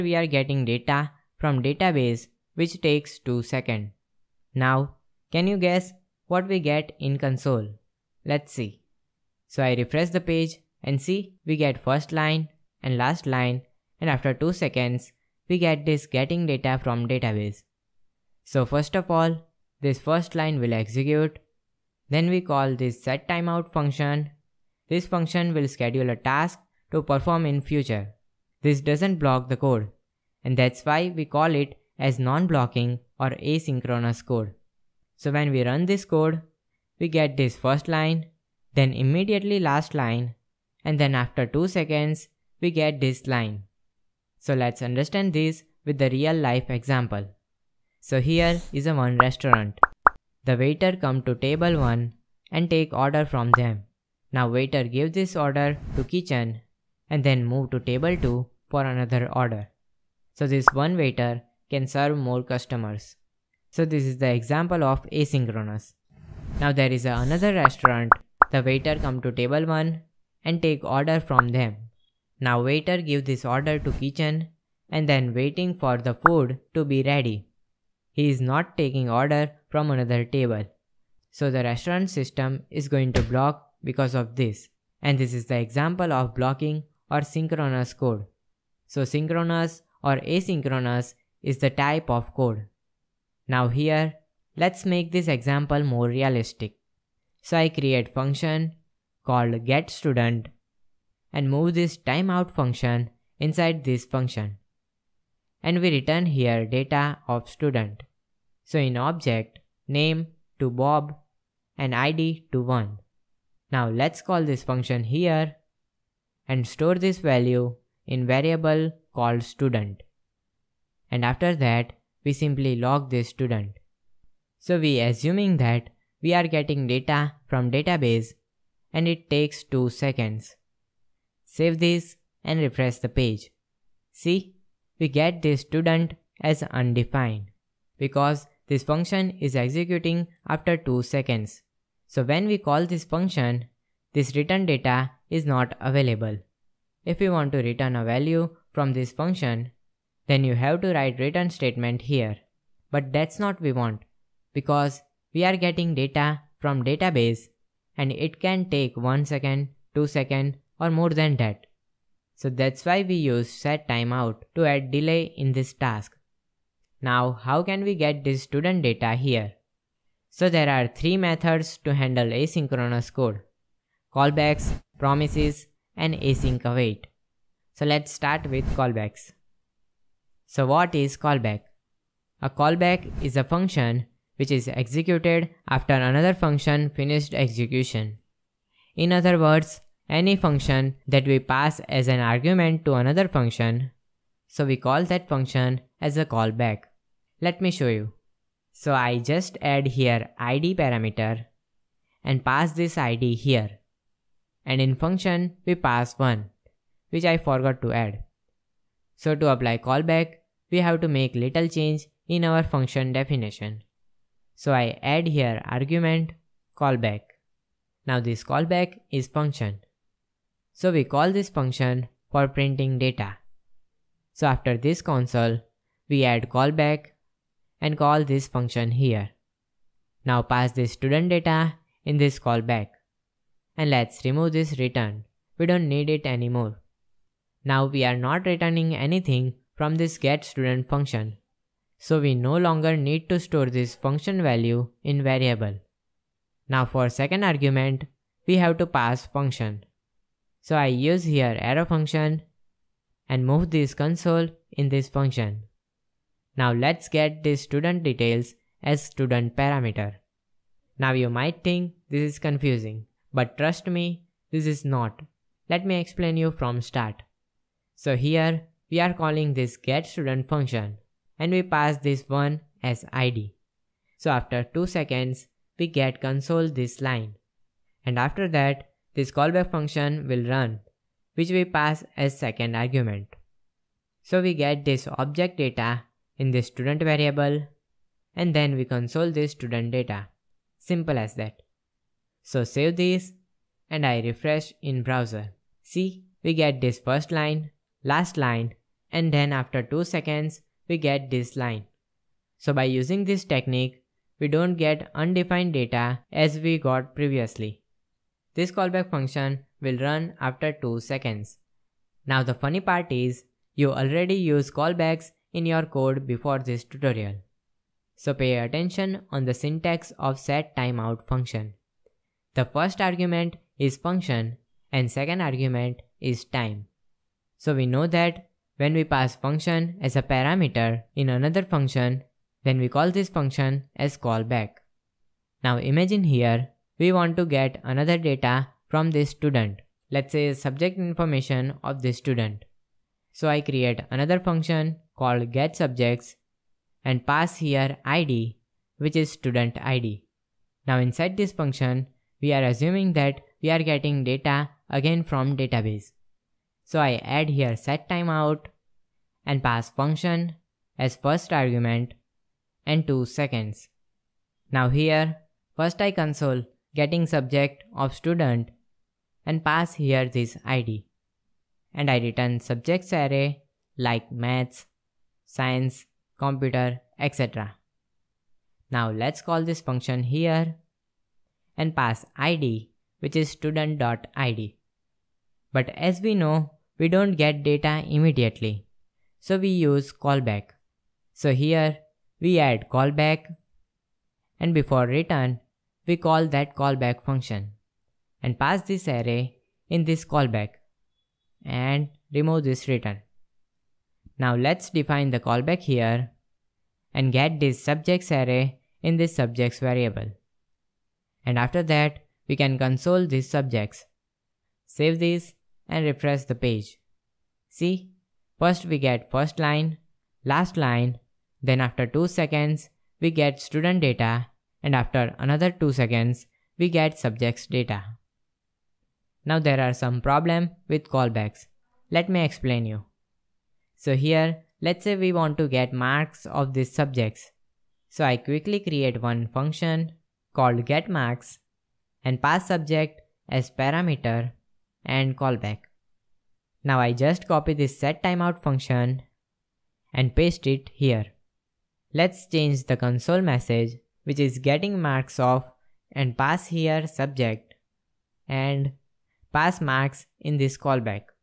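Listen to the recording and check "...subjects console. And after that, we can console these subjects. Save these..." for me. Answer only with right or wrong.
wrong.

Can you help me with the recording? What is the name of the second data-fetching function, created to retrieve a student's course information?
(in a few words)
getSubjects.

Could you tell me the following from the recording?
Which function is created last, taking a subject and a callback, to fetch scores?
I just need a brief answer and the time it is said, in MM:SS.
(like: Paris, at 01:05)
getMarks, at 07:20.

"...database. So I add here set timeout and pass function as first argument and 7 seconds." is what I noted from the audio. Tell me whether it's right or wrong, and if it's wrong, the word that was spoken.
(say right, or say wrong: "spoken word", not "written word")
wrong: "2", not "7".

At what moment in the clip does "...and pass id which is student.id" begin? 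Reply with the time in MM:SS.
06:21.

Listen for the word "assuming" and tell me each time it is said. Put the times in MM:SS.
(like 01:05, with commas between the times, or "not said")
02:05, 05:52.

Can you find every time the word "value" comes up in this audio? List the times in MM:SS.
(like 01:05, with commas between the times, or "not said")
01:57, 02:28, 04:04.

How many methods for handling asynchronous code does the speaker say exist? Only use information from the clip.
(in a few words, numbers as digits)
3.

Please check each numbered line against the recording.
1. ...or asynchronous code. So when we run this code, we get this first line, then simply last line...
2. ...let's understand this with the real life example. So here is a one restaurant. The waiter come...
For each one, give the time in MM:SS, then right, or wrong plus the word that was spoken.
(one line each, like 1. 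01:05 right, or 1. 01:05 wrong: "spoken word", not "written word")
1. 00:33 wrong: "immediately", not "simply"
2. 00:44 right.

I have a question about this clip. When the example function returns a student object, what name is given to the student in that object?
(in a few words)
Bob.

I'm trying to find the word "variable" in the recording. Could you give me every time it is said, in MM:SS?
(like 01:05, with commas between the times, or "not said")
01:58, 04:05, 04:47, 06:49.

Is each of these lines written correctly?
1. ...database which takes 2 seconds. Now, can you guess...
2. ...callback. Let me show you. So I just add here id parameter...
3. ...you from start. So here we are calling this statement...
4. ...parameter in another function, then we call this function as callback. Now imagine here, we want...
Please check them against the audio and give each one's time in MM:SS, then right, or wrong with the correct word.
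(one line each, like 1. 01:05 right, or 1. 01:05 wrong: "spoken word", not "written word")
1. 00:01 right
2. 03:16 right
3. 04:26 wrong: "getStudent", not "statement"
4. 05:30 right.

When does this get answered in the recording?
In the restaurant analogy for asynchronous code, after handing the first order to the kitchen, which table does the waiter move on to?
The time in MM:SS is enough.
00:57.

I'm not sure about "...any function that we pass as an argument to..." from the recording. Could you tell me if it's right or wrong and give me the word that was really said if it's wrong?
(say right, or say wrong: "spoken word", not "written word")
right.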